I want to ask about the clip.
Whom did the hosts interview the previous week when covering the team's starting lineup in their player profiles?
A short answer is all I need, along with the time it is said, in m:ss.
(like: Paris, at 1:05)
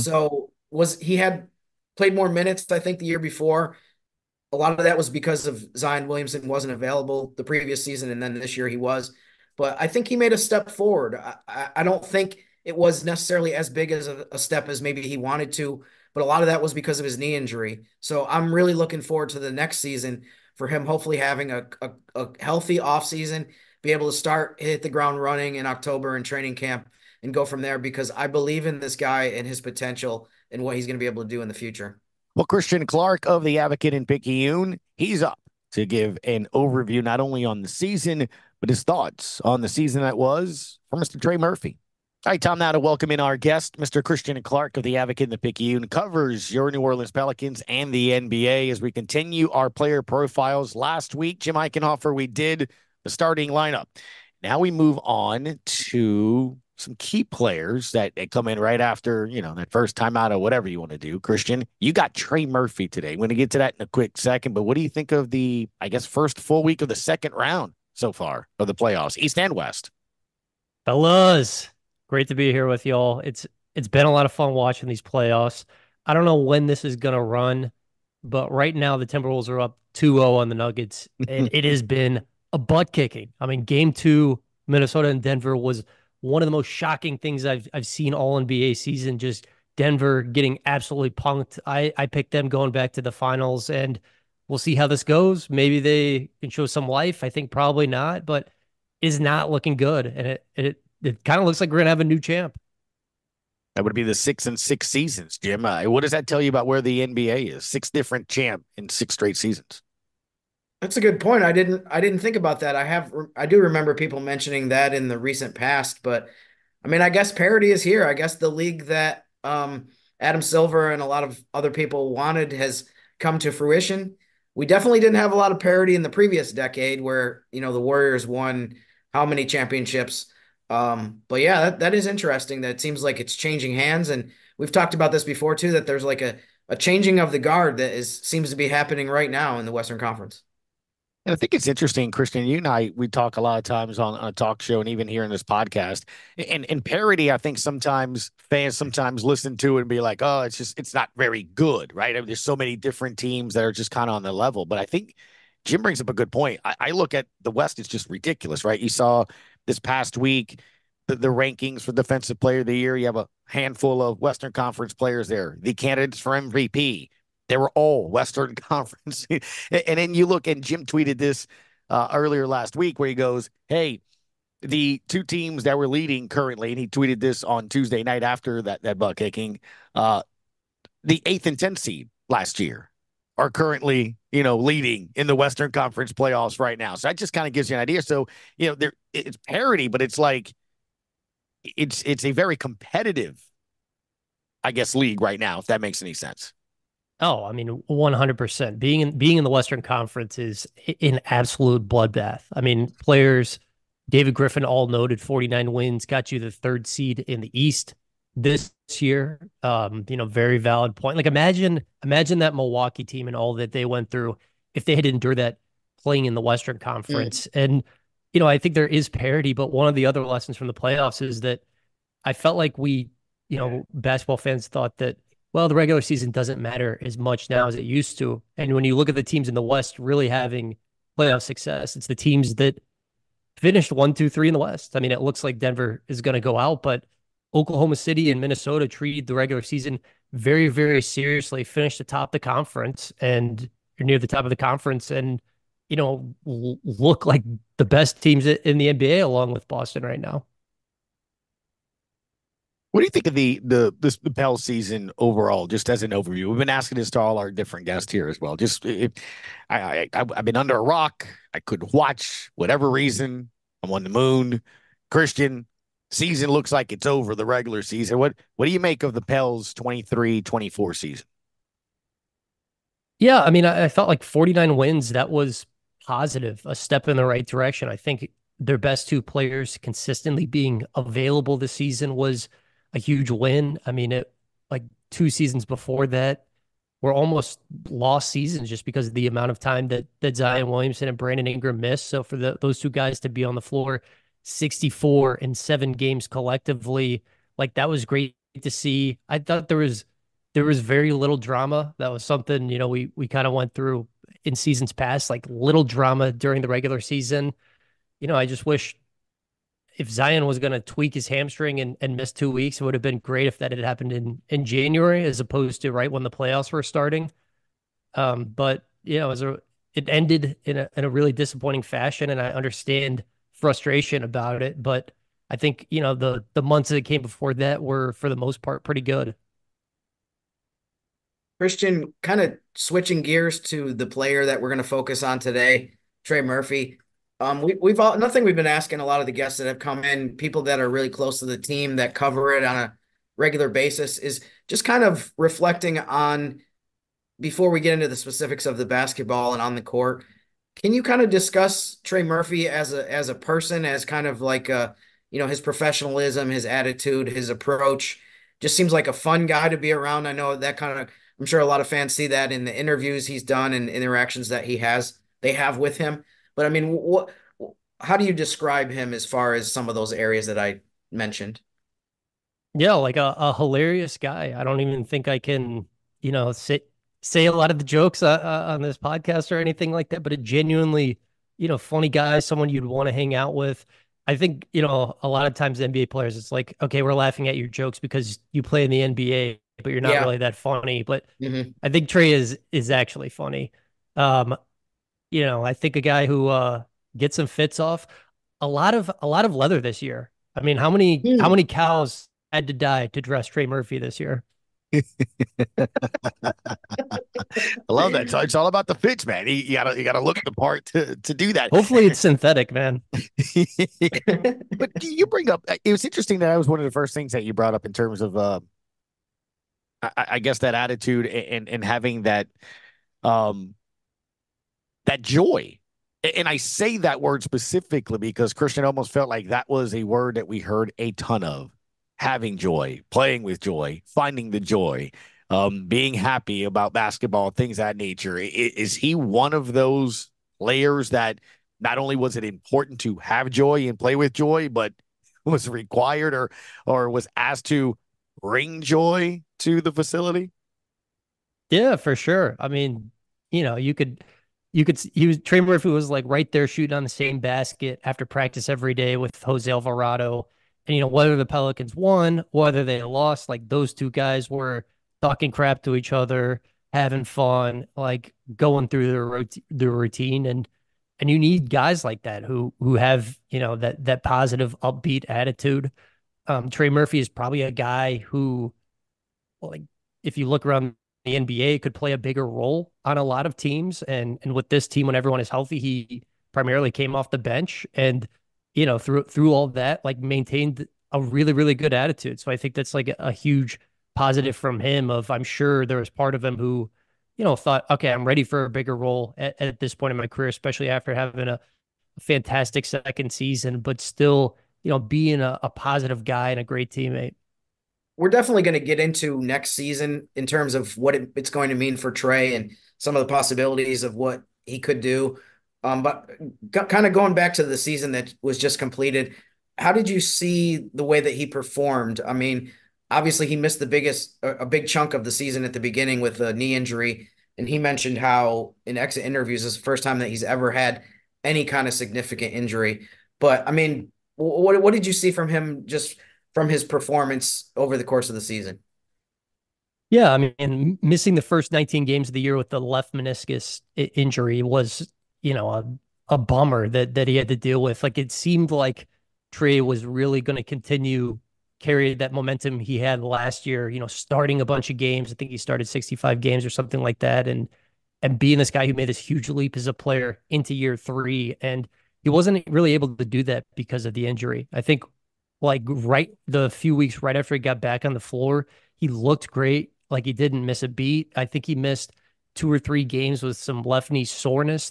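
Jim Eichenhofer, at 0:51.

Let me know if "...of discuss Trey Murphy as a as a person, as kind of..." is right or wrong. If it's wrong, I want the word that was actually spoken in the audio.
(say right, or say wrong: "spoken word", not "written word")
right.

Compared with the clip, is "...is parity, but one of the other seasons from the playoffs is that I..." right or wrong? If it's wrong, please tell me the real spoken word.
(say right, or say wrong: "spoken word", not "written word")
wrong: "lessons", not "seasons".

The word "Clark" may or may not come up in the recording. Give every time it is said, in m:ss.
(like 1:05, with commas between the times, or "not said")
0:32, 0:44.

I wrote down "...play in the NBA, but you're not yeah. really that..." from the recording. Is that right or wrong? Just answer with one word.
right.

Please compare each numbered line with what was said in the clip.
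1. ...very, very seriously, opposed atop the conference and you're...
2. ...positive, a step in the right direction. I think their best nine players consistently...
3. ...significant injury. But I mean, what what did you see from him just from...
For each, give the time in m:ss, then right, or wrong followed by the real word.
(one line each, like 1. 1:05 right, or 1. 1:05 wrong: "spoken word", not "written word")
1. 4:00 wrong: "finished", not "opposed"
2. 4:36 wrong: "two", not "nine"
3. 8:51 right.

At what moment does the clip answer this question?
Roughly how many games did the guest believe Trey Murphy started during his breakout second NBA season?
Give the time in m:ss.
9:15.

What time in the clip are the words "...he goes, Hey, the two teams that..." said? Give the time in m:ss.
2:53.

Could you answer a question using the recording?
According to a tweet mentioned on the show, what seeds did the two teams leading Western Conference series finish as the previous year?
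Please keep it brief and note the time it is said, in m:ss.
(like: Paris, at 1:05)
8th and 10th, at 3:01.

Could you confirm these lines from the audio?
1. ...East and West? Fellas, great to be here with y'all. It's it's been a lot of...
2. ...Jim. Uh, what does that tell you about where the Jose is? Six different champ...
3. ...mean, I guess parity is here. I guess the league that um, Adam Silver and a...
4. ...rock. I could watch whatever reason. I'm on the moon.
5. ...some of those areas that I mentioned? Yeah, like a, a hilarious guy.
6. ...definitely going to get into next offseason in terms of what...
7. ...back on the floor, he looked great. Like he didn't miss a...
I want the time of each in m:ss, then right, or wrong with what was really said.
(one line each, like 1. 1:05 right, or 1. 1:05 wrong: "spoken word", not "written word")
1. 1:09 right
2. 1:45 wrong: "NBA", not "Jose"
3. 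1:56 right
4. 4:20 right
5. 6:09 right
6. 8:28 wrong: "season", not "offseason"
7. 9:27 right.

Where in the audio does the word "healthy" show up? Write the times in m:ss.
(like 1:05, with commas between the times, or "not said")
0:22, 8:05.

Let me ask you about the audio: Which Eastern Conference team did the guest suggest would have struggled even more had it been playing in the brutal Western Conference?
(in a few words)
Milwaukee.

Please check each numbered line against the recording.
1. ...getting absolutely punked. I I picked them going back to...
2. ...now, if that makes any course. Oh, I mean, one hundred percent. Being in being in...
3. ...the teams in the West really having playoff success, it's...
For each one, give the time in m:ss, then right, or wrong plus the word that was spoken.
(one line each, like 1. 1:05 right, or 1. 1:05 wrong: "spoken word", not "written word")
1. 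1:30 right
2. 3:15 wrong: "sense", not "course"
3. 3:49 right.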